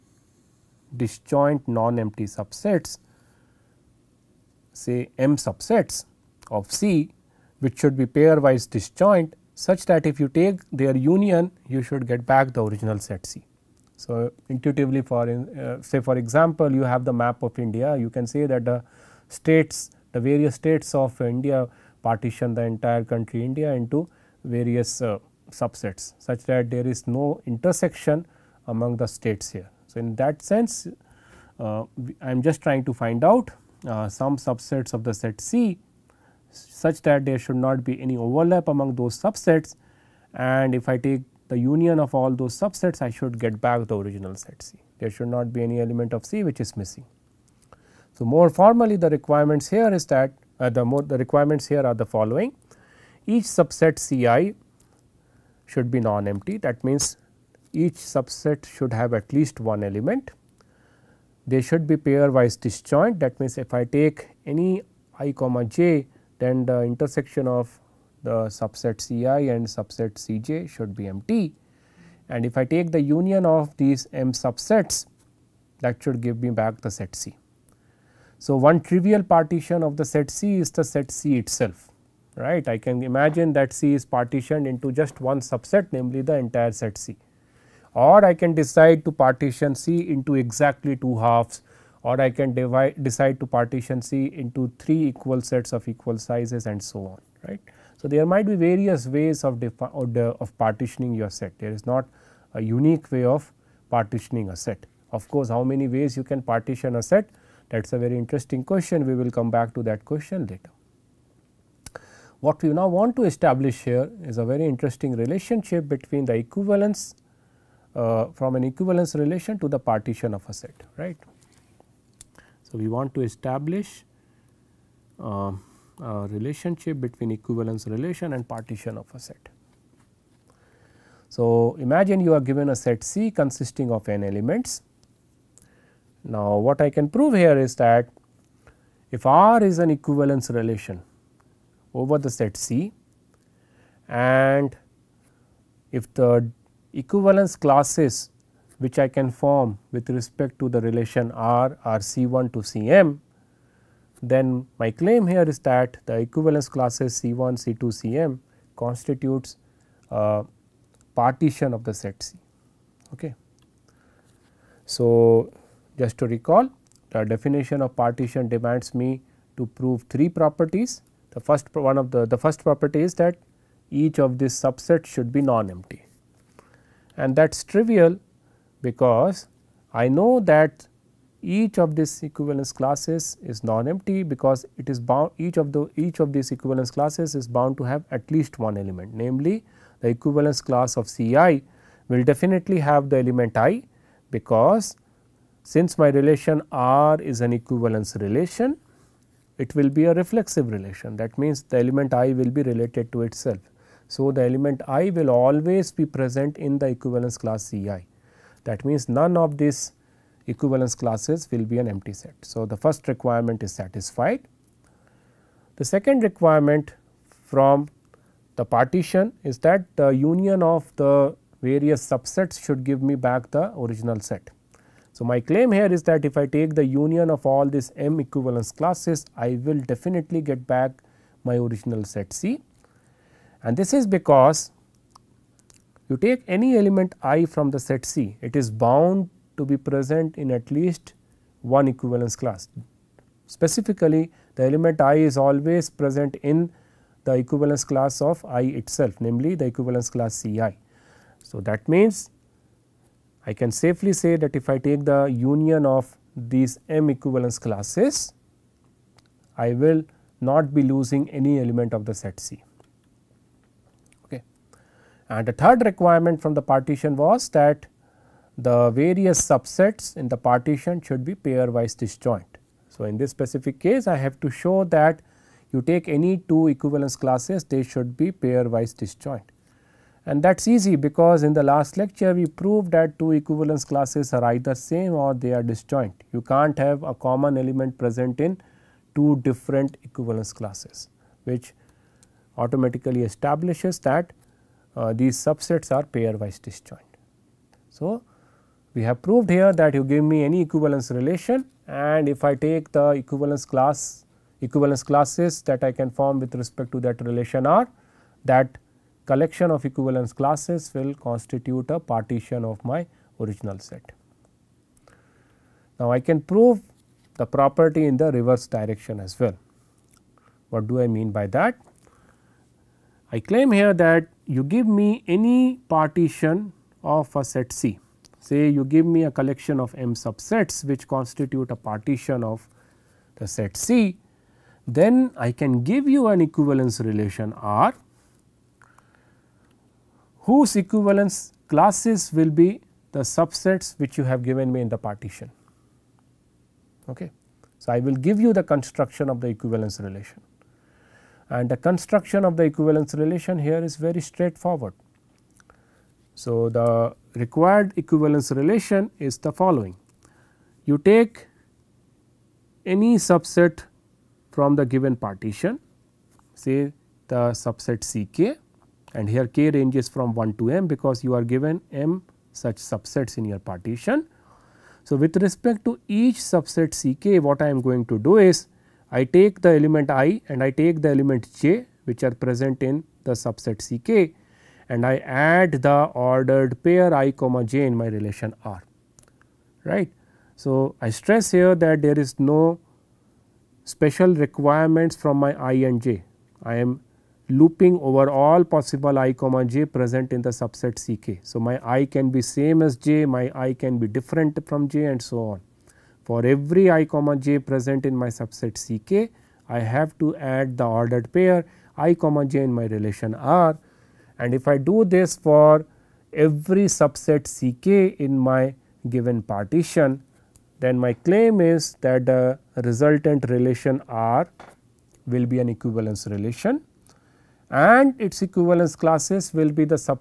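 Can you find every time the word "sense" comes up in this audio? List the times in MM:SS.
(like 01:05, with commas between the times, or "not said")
00:30.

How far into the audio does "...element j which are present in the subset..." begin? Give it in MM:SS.
06:21.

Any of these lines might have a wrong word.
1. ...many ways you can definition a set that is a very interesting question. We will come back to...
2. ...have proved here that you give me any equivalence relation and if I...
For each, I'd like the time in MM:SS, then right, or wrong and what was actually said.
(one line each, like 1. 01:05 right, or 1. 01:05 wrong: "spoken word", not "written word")
1. 01:45 wrong: "partition", not "definition"
2. 04:59 right.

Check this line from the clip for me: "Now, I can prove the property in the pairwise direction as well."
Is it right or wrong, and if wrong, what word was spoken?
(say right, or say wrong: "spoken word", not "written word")
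wrong: "reverse", not "pairwise".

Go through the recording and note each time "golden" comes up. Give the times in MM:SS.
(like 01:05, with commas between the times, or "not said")
not said.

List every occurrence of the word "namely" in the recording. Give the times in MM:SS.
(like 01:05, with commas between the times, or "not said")
01:25, 03:09, 04:09.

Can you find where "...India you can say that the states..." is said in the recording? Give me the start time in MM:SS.
00:17.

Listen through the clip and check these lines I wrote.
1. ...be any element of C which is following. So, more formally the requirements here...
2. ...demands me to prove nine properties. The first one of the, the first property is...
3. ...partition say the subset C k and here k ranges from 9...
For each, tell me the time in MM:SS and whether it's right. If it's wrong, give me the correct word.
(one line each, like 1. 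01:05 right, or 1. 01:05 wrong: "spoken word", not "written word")
1. 00:45 wrong: "missing", not "following"
2. 02:48 wrong: "three", not "nine"
3. 06:05 wrong: "1", not "9".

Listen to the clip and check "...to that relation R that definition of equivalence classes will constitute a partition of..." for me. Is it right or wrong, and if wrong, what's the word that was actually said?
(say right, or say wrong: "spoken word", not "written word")
wrong: "collection", not "definition".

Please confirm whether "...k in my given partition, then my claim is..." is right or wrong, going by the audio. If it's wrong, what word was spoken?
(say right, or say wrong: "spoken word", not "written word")
right.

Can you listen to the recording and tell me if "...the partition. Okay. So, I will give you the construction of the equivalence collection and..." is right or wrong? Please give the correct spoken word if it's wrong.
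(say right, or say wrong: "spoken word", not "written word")
wrong: "relation", not "collection".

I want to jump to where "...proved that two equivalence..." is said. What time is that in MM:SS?
04:42.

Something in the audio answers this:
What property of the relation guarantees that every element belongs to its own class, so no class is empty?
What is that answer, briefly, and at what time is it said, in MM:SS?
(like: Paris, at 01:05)
Reflexive, at 03:20.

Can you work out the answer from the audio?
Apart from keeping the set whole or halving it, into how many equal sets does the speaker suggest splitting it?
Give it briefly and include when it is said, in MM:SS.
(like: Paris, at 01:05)
3, at 01:34.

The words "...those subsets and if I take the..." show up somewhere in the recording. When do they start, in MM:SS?
00:38.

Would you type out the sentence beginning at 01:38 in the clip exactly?
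So, there might be various ways of, of partitioning your set.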